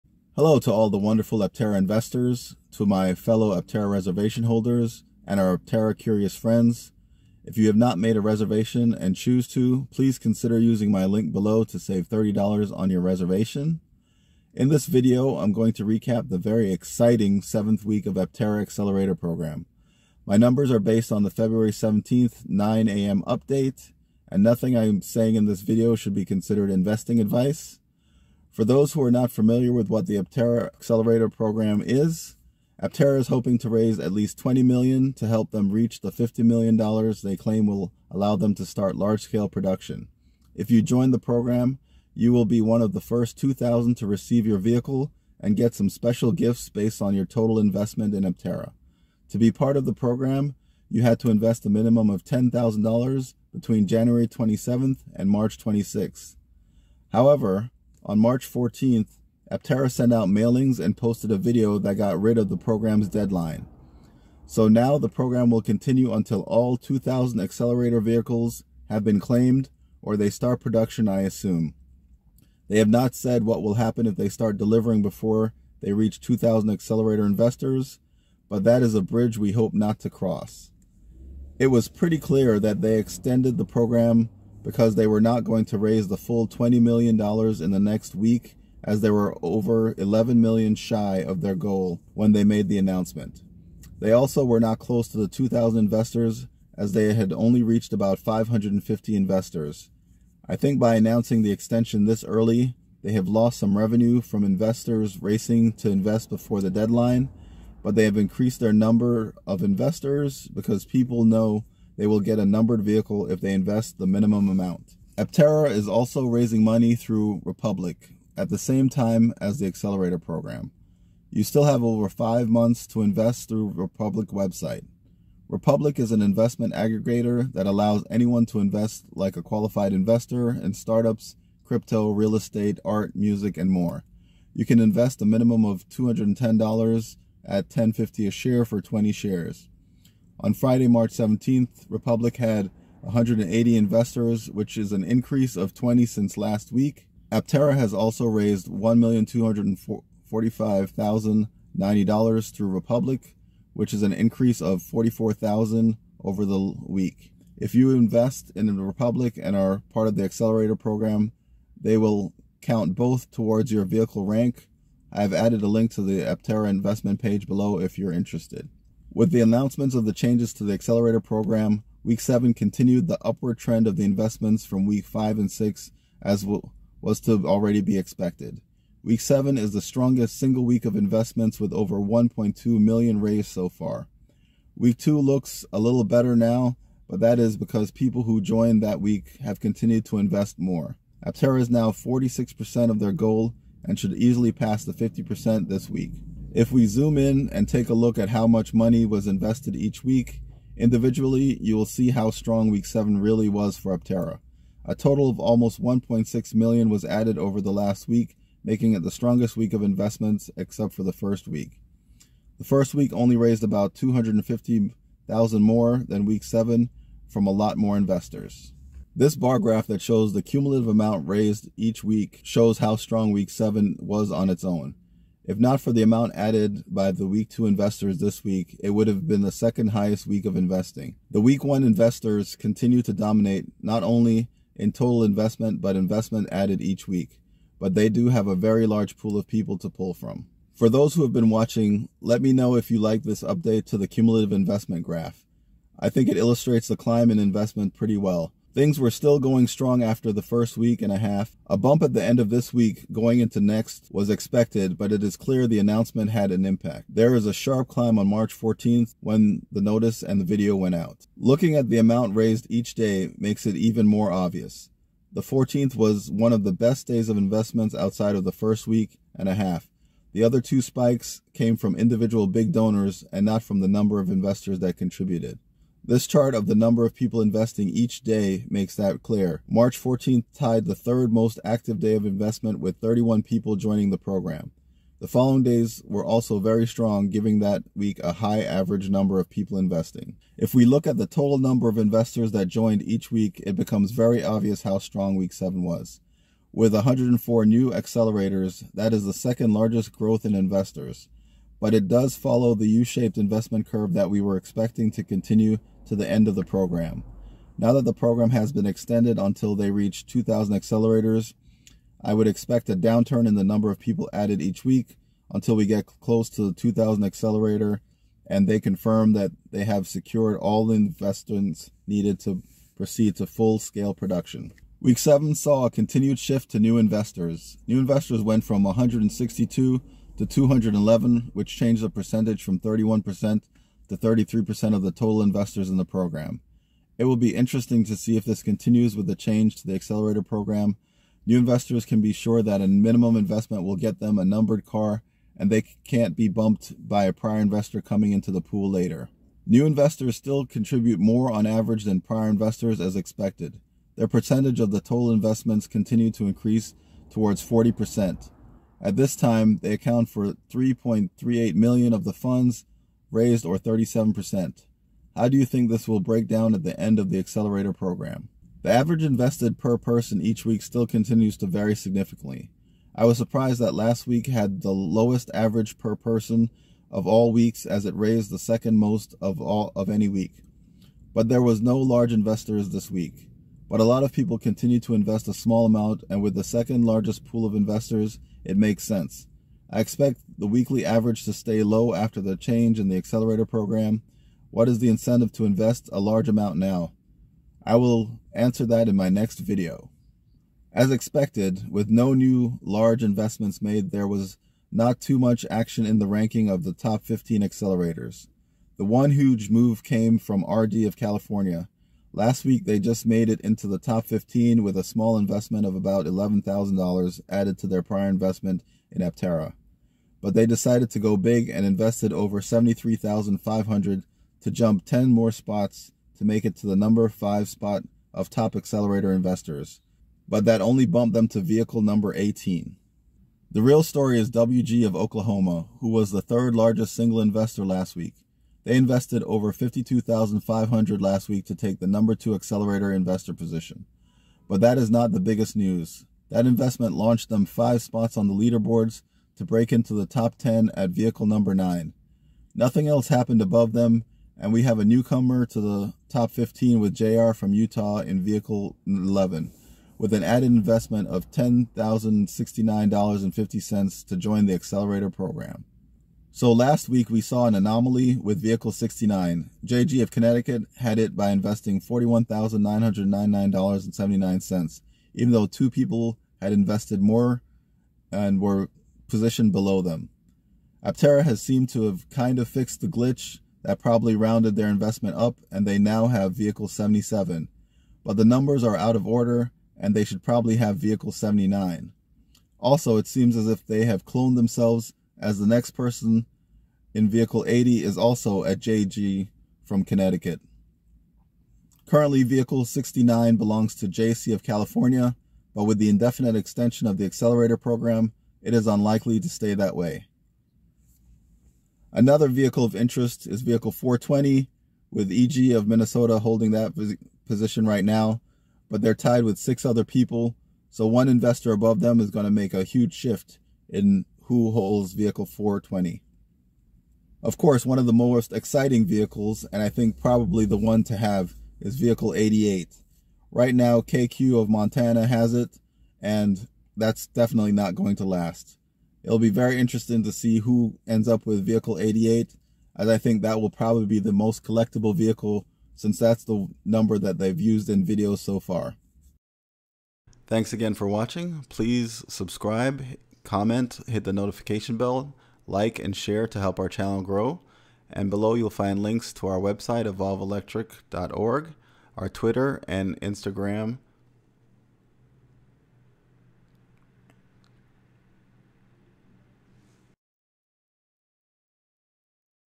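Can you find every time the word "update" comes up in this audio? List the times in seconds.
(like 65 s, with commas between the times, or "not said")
23 s, 243 s.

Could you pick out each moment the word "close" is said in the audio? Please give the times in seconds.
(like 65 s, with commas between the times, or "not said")
94 s, 316 s.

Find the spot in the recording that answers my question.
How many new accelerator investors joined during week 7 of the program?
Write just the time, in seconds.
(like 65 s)
296 s.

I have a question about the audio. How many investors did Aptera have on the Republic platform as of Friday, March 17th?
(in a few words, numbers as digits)
180.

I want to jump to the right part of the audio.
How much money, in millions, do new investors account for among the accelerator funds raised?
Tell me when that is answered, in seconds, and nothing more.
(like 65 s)
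360 s.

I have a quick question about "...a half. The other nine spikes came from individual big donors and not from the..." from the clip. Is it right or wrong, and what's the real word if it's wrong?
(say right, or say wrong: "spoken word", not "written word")
wrong: "two", not "nine".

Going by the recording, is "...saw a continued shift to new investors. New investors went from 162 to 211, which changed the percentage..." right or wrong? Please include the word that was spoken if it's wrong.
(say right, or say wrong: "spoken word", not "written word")
right.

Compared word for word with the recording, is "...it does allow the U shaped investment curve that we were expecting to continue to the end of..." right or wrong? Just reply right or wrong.
wrong.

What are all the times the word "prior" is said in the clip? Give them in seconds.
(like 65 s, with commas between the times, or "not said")
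347 s, 352 s, 418 s.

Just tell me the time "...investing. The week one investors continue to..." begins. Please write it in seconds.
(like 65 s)
230 s.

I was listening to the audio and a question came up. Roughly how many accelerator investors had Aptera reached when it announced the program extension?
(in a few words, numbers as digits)
about 550.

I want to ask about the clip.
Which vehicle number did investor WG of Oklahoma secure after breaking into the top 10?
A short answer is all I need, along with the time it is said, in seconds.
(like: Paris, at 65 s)
9, at 451 s.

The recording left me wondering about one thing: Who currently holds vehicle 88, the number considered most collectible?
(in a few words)
KQ of Montana.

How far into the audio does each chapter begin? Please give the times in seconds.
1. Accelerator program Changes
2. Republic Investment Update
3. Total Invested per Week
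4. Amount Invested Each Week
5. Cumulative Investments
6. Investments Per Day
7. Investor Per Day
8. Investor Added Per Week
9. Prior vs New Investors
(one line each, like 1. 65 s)
1. 56 s
2. 115 s
3. 196 s
4. 219 s
5. 240 s
6. 261 s
7. 276 s
8. 290 s
9. 325 s.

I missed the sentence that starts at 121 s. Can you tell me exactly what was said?
You still have over five months to invest through Republic website.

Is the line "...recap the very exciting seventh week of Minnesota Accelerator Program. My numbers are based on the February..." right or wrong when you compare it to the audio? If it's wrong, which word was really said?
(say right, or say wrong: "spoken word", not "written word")
wrong: "Aptera", not "Minnesota".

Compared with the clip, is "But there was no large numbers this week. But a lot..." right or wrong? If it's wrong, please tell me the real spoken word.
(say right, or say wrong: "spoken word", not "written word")
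wrong: "investors", not "numbers".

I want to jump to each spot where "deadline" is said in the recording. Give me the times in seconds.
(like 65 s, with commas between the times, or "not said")
63 s, 106 s.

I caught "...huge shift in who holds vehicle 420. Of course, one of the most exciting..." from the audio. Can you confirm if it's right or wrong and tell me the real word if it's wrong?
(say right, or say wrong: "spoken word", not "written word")
right.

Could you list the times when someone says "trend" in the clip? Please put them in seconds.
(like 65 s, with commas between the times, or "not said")
173 s.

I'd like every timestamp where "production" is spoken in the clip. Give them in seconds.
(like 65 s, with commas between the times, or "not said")
39 s, 70 s, 324 s.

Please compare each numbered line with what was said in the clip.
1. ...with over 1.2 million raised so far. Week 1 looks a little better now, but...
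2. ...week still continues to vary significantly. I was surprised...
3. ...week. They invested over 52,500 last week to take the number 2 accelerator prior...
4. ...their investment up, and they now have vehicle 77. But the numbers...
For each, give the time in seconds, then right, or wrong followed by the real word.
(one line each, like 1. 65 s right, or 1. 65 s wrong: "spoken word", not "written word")
1. 181 s wrong: "2", not "1"
2. 370 s right
3. 438 s wrong: "investor", not "prior"
4. 484 s right.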